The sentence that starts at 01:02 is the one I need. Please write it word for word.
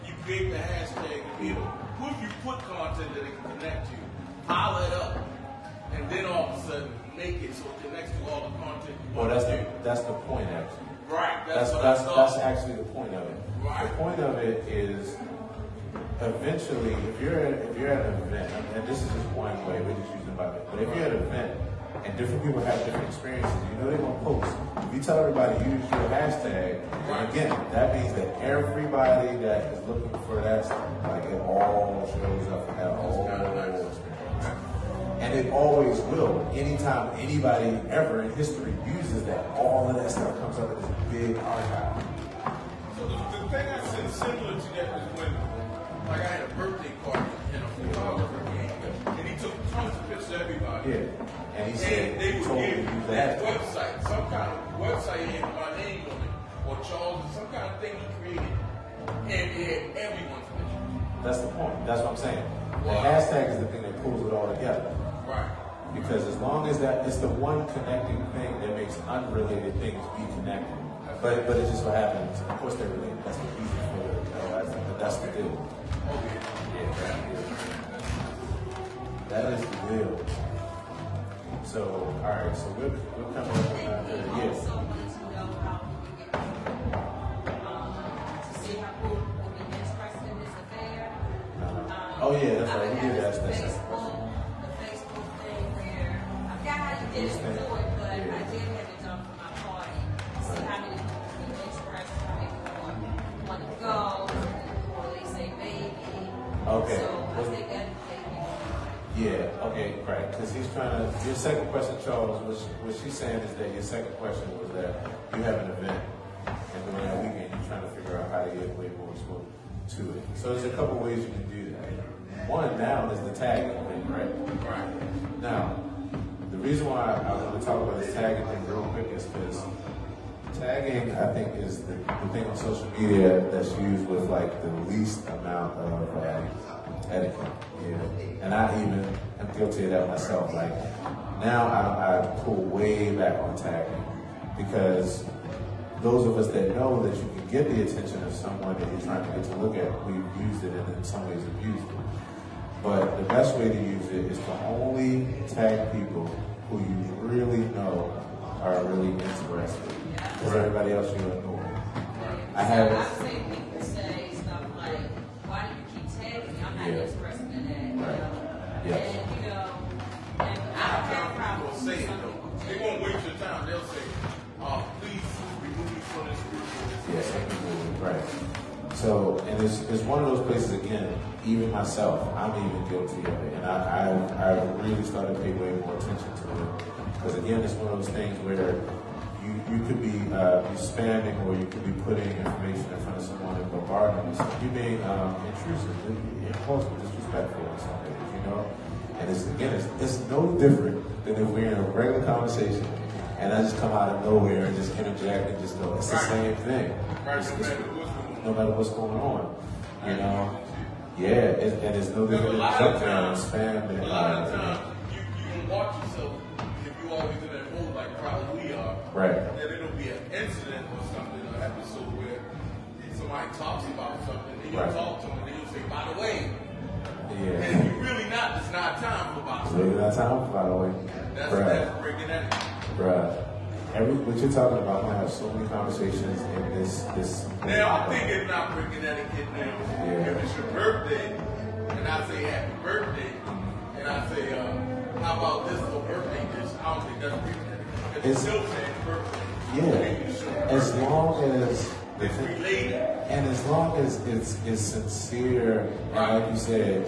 The hashtag is the thing that pulls it all together.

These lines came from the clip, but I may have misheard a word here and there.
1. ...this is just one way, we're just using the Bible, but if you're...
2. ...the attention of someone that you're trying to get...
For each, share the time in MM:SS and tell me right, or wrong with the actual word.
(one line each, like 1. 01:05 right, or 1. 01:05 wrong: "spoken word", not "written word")
1. 00:18 right
2. 02:27 right.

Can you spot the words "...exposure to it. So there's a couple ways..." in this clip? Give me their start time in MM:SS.
01:59.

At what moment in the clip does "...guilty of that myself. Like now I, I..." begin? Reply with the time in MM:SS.
02:19.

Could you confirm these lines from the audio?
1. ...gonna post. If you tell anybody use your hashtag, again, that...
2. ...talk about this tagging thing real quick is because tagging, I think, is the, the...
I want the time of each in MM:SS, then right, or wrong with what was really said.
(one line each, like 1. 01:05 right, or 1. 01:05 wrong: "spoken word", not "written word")
1. 00:23 wrong: "everybody", not "anybody"
2. 02:07 right.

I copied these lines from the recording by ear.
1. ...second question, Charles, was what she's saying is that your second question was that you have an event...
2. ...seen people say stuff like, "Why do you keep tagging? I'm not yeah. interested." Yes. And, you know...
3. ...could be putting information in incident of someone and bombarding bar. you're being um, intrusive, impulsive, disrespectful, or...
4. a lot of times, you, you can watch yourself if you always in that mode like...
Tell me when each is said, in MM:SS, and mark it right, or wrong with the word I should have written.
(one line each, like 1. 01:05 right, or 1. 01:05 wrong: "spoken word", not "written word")
1. 01:51 right
2. 02:43 right
3. 03:11 wrong: "front", not "incident"
4. 03:34 right.